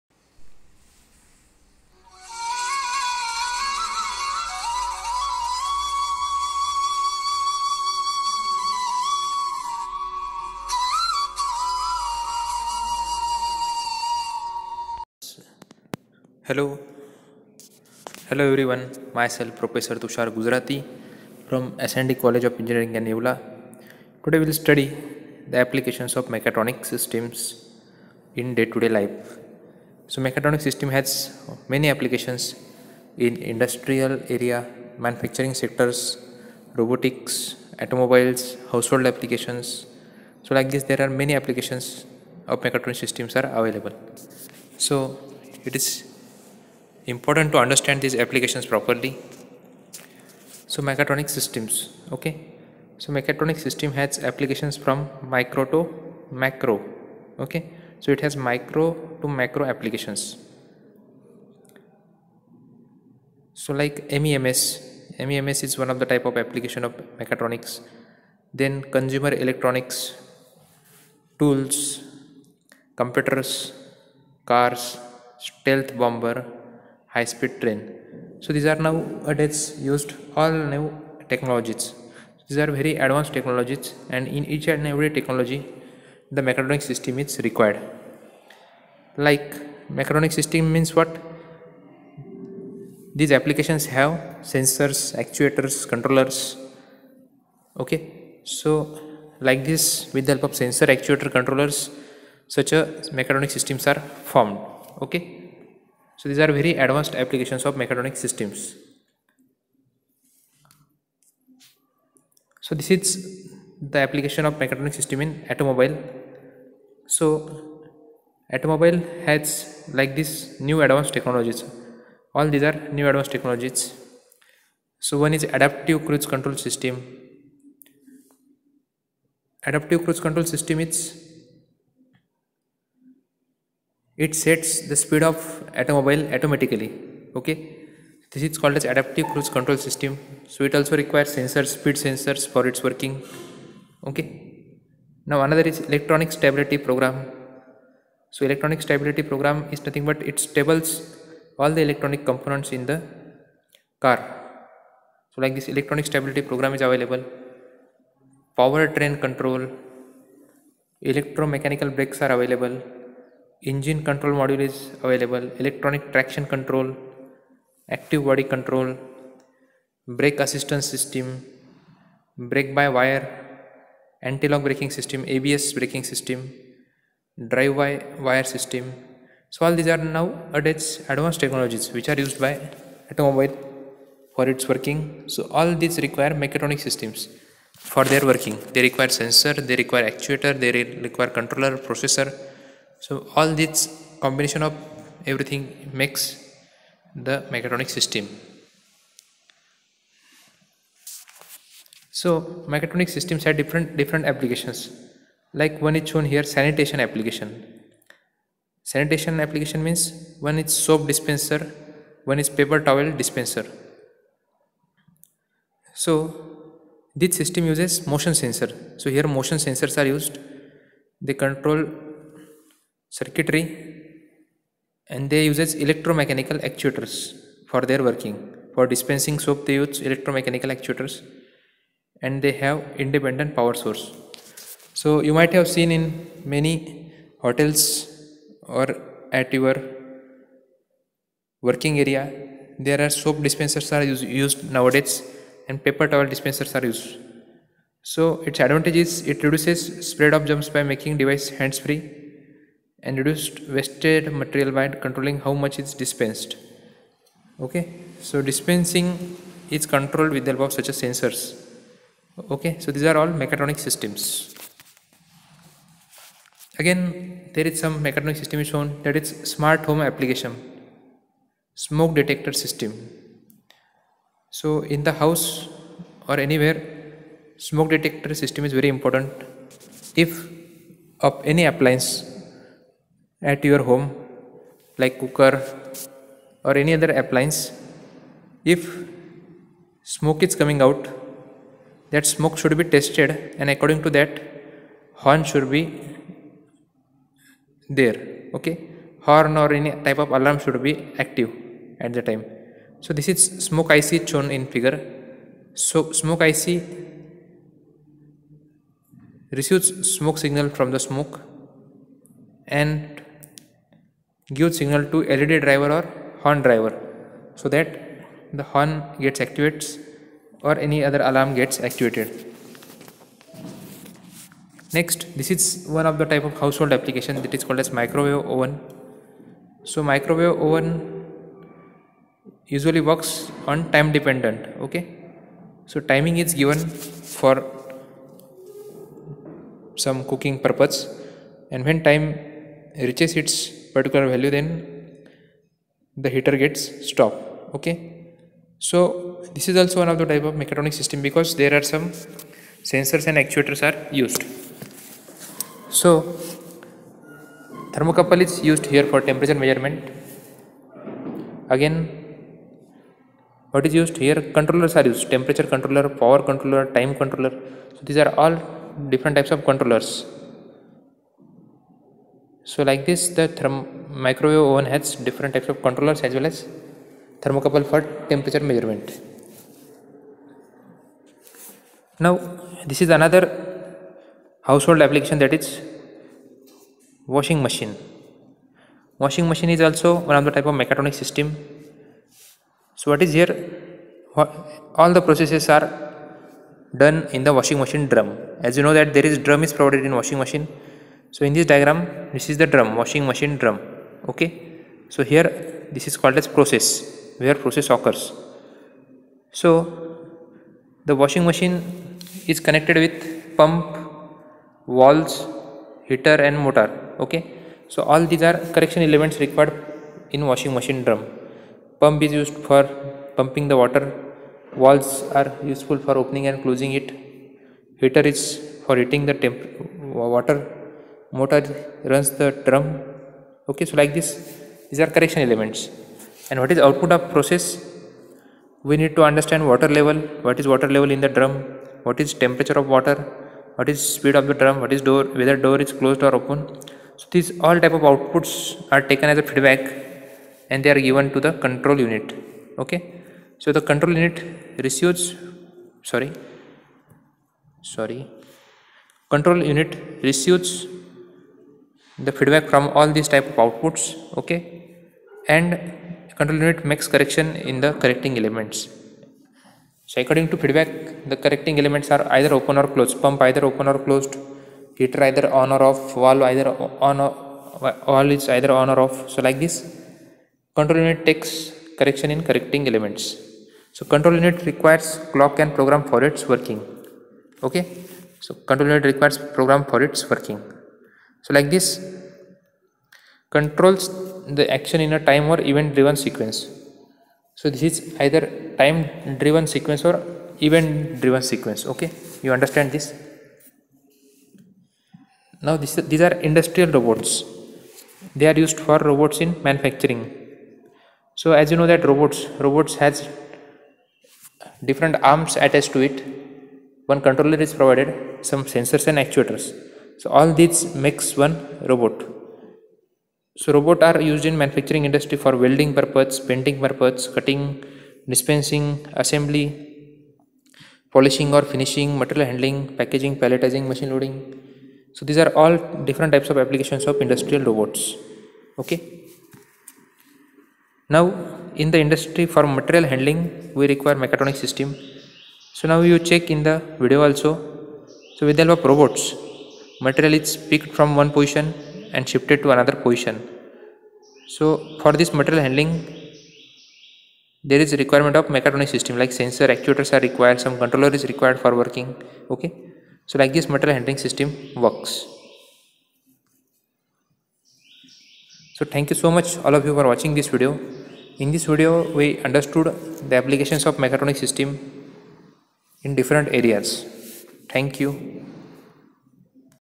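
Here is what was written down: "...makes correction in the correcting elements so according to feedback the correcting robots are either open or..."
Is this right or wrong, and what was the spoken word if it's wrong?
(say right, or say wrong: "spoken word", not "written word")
wrong: "elements", not "robots".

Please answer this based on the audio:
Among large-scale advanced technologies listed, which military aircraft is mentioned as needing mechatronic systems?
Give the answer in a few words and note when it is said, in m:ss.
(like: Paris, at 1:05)
Stealth bomber, at 1:15.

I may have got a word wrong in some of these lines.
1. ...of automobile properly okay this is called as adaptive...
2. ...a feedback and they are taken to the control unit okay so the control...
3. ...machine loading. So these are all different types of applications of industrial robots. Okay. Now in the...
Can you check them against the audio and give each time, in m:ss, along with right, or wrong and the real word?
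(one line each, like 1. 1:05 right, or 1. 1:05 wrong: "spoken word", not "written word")
1. 2:15 wrong: "automatically", not "properly"
2. 7:29 wrong: "given", not "taken"
3. 8:53 right.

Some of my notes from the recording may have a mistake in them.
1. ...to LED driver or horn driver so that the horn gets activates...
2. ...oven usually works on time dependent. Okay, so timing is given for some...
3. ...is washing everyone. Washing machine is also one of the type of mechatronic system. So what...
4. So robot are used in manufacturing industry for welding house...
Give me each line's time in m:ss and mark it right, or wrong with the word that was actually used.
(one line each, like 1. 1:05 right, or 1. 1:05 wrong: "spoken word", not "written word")
1. 5:15 right
2. 5:30 right
3. 6:25 wrong: "machine", not "everyone"
4. 8:43 wrong: "purpose", not "house".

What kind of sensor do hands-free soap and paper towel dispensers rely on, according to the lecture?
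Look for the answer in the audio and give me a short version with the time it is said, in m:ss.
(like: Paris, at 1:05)
Motion sensor, at 3:38.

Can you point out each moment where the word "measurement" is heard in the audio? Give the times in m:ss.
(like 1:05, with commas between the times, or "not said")
5:59, 6:18.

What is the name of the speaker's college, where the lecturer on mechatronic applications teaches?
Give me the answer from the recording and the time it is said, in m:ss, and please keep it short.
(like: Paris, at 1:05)
SND College of Engineering, at 0:21.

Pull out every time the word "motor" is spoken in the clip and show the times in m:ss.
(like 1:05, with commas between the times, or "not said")
6:56, 7:11.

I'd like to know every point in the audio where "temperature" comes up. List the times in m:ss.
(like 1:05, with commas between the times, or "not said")
5:59, 6:05, 6:18, 7:22.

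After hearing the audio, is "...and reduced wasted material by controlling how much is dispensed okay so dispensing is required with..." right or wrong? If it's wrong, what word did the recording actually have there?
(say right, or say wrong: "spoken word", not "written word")
wrong: "controlled", not "required".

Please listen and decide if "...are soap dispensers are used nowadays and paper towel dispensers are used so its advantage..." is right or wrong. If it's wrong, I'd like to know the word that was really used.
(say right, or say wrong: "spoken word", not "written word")
right.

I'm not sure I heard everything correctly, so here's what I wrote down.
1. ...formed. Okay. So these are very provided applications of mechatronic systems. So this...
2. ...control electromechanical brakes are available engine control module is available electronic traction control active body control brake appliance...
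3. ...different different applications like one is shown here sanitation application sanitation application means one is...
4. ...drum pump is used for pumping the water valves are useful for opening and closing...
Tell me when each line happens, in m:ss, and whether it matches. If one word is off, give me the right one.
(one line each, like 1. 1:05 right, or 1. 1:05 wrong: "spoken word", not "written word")
1. 1:44 wrong: "advanced", not "provided"
2. 2:39 wrong: "assistance", not "appliance"
3. 3:23 right
4. 7:01 right.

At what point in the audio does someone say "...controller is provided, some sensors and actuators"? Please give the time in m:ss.
8:37.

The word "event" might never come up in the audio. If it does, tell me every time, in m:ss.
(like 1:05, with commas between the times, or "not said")
8:15, 8:20.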